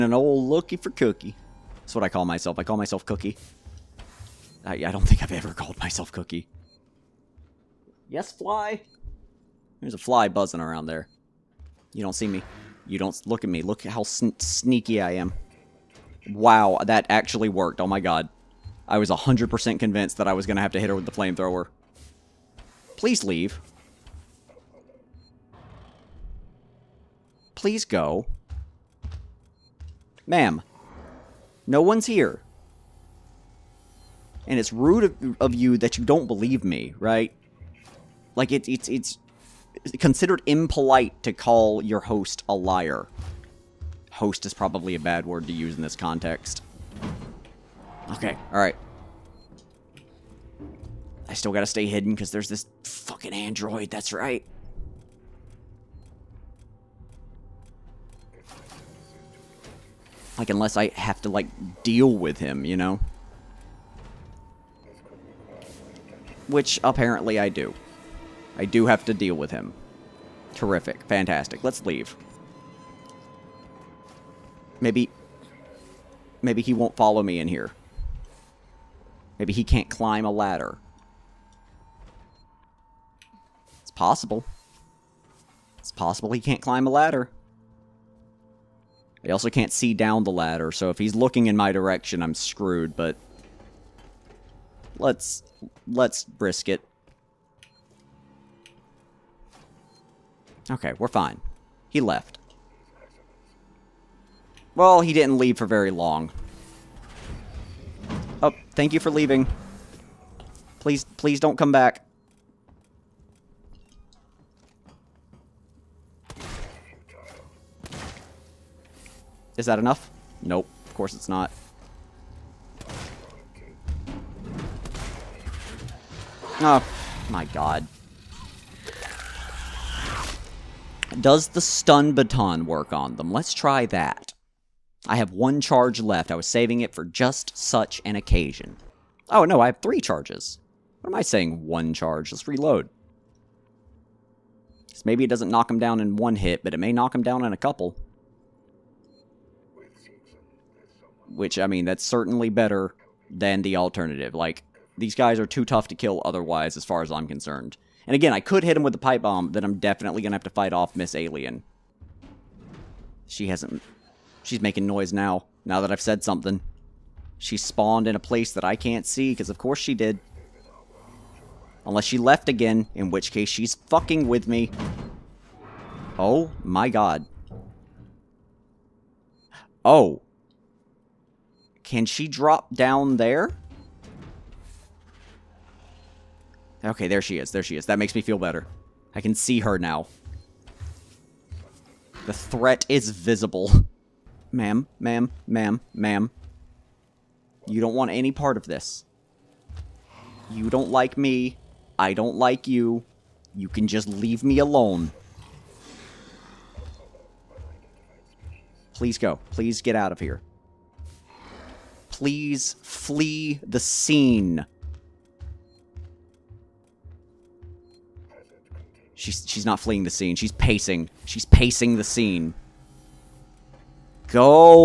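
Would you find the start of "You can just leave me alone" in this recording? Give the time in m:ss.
3:23.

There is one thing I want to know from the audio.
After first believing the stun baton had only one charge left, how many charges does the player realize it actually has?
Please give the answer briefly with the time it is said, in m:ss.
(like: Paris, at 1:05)
3, at 2:19.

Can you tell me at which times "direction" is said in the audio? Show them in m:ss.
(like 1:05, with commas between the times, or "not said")
1:31.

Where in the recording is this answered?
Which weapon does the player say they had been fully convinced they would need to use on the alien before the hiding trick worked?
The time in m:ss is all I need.
0:21.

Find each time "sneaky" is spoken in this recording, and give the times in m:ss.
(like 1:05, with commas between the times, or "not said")
0:14.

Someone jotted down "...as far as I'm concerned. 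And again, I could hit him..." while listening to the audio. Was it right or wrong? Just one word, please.
right.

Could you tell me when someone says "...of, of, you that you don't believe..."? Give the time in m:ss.
0:35.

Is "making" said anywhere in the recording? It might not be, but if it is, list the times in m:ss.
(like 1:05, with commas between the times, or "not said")
2:44.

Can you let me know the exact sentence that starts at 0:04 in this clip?
I, I don't think I've ever called myself Cookie.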